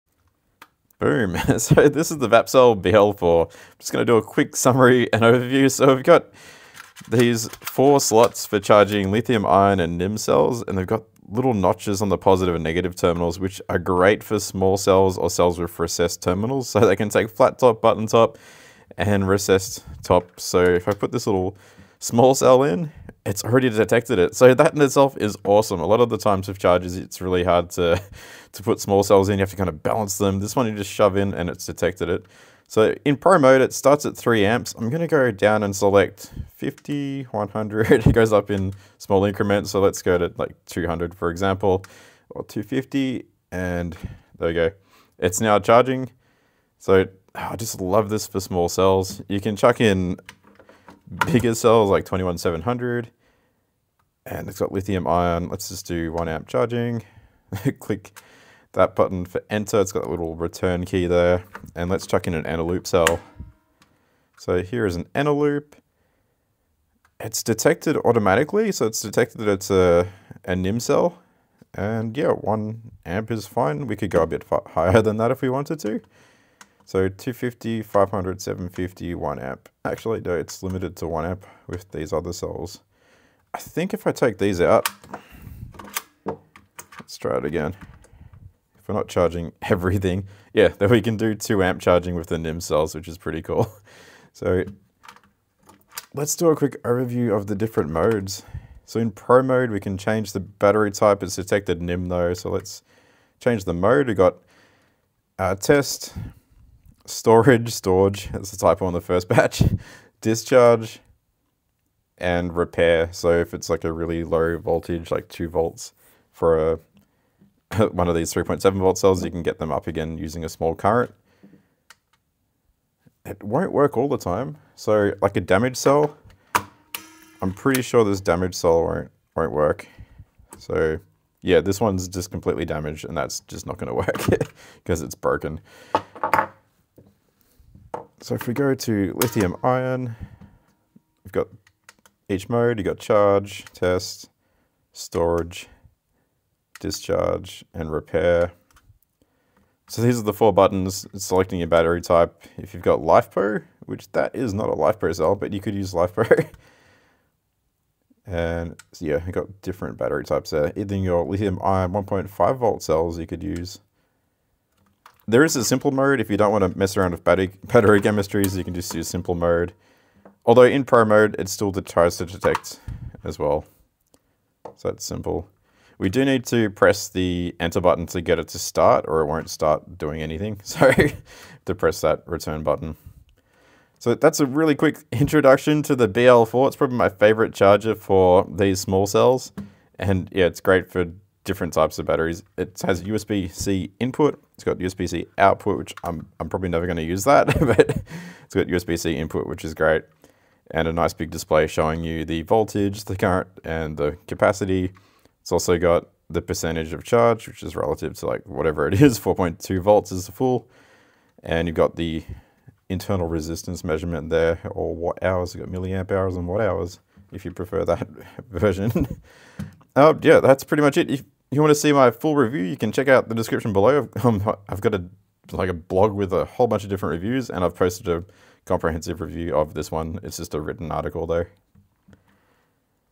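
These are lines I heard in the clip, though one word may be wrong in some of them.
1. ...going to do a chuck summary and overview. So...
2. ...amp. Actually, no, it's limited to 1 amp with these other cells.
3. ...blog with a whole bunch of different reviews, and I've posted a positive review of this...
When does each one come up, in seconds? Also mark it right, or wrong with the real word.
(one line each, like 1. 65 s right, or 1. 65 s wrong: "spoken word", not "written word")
1. 3 s wrong: "quick", not "chuck"
2. 79 s right
3. 225 s wrong: "comprehensive", not "positive".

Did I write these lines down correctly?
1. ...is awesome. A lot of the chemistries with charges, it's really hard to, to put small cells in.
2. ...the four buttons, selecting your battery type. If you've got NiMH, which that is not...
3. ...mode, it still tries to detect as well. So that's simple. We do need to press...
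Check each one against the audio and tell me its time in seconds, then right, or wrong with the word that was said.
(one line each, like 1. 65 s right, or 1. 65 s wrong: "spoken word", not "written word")
1. 25 s wrong: "times", not "chemistries"
2. 150 s wrong: "LiFePo", not "NiMH"
3. 171 s right.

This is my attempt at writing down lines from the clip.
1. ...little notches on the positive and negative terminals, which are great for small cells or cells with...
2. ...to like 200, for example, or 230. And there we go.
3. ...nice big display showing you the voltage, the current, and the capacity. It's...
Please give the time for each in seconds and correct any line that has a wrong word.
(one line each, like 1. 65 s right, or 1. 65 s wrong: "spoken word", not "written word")
1. 11 s right
2. 40 s wrong: "250", not "230"
3. 200 s right.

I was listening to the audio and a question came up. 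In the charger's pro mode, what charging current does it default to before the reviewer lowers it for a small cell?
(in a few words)
3 amps.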